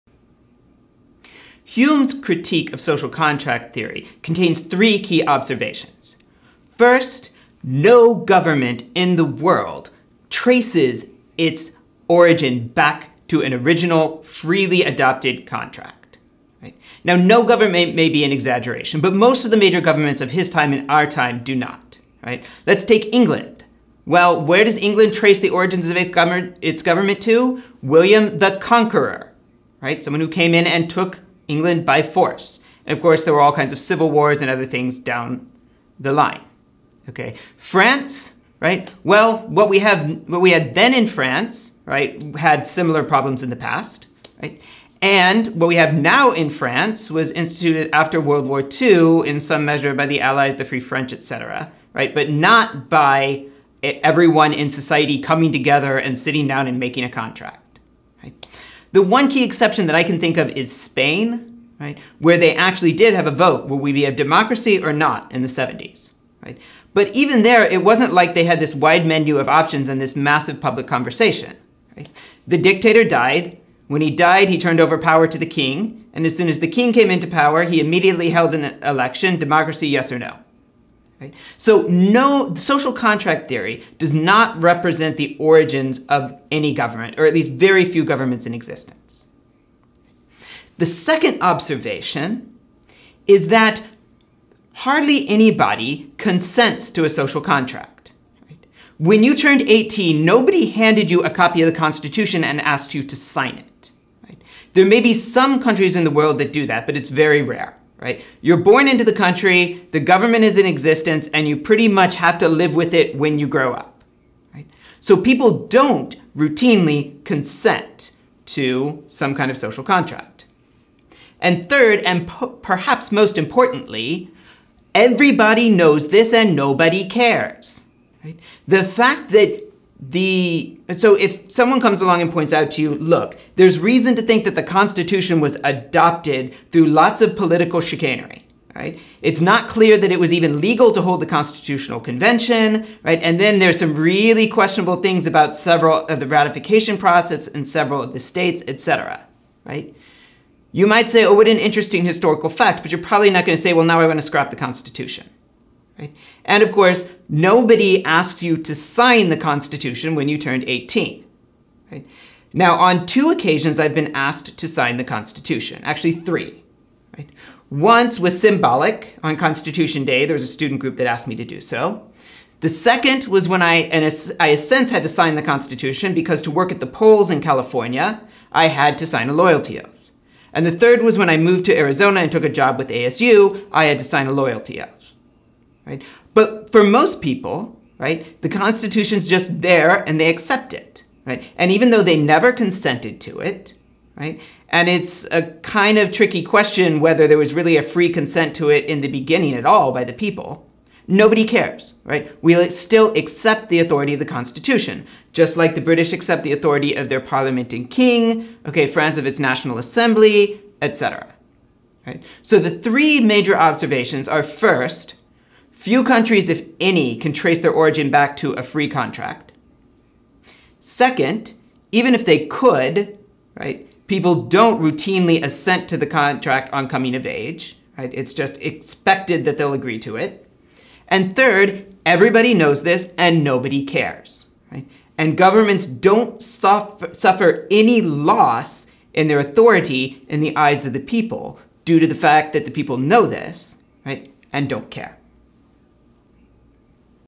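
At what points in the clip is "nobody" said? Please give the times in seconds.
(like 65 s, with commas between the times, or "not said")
100 s, 126 s, 157 s, 201 s, 233 s.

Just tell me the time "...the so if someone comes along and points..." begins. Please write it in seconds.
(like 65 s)
130 s.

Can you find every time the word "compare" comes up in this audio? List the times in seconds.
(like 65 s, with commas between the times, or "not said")
not said.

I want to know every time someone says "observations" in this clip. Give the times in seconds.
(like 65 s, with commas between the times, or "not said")
5 s, 91 s, 213 s.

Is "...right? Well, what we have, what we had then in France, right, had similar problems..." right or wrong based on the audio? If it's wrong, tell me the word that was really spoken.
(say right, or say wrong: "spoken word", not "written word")
right.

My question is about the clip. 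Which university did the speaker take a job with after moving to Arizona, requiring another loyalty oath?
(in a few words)
ASU.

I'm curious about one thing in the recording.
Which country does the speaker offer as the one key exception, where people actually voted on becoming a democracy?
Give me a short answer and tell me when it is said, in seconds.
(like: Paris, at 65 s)
Spain, at 60 s.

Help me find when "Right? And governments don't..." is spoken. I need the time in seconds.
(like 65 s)
234 s.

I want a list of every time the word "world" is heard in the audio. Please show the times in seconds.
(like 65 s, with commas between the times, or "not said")
9 s, 48 s, 106 s.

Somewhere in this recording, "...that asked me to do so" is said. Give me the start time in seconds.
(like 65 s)
170 s.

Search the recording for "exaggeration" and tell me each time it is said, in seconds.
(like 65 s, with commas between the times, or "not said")
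18 s.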